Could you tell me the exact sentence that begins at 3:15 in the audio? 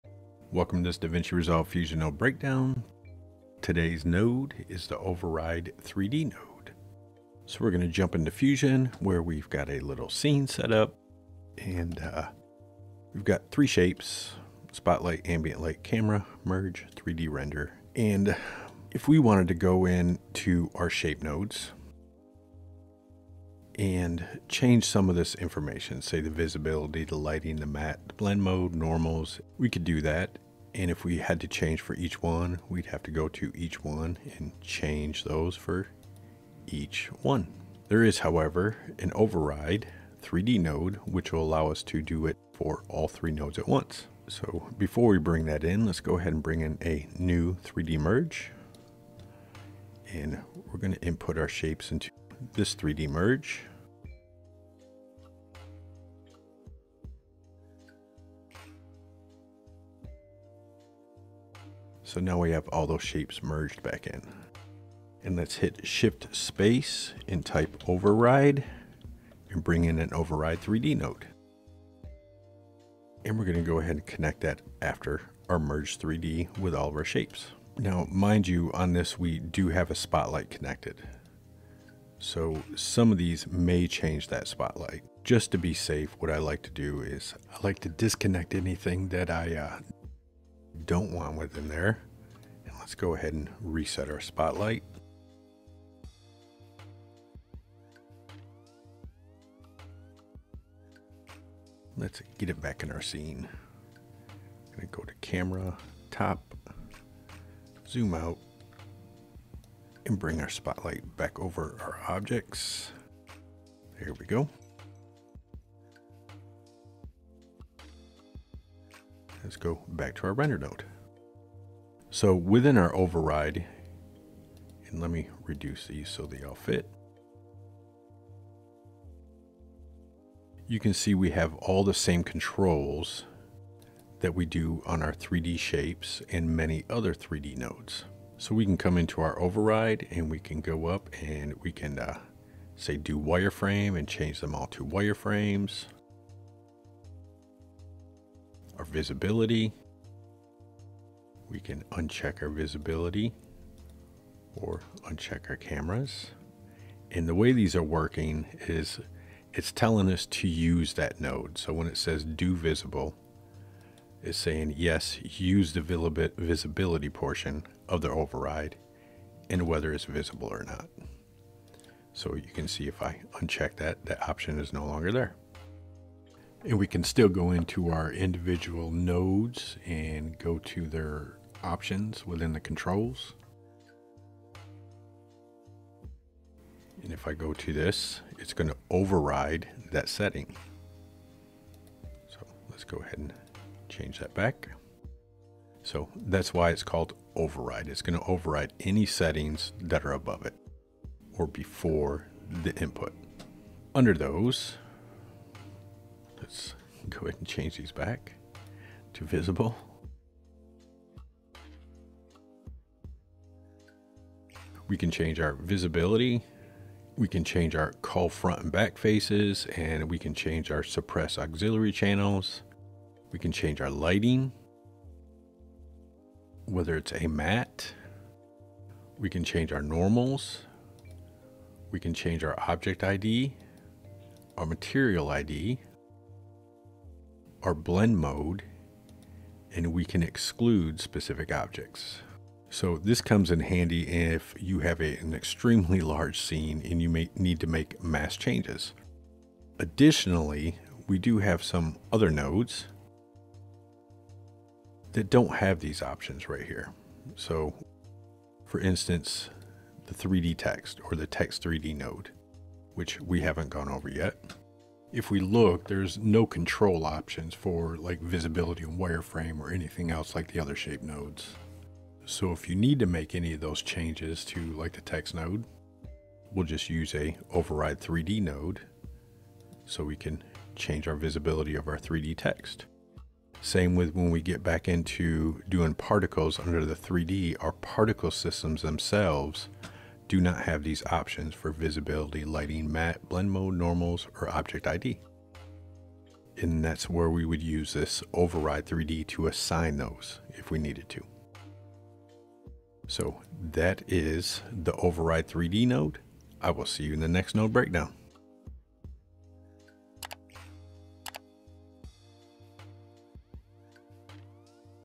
So that's why it's called override.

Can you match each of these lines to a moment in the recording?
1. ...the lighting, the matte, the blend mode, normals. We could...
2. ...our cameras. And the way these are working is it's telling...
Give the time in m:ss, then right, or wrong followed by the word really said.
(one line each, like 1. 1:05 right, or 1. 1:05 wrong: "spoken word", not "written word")
1. 0:27 right
2. 2:35 right.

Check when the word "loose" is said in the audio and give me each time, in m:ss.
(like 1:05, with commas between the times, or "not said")
not said.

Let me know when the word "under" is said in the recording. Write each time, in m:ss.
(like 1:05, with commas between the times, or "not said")
3:23, 4:46.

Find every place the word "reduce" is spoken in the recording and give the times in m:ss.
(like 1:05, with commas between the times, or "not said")
2:05.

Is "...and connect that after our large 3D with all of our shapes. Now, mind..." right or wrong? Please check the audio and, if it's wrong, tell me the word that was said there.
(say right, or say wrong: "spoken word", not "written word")
wrong: "merge", not "large".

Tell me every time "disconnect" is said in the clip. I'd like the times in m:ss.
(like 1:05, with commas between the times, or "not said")
1:27.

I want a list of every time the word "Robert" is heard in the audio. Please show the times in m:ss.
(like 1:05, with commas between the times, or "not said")
not said.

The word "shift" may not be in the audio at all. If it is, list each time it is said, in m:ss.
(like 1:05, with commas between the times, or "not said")
1:05.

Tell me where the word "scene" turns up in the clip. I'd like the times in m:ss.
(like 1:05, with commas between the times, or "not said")
0:10, 1:43, 4:06.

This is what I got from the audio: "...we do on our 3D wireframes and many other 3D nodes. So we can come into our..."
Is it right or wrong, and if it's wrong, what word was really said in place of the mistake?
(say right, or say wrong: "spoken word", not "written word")
wrong: "shapes", not "wireframes".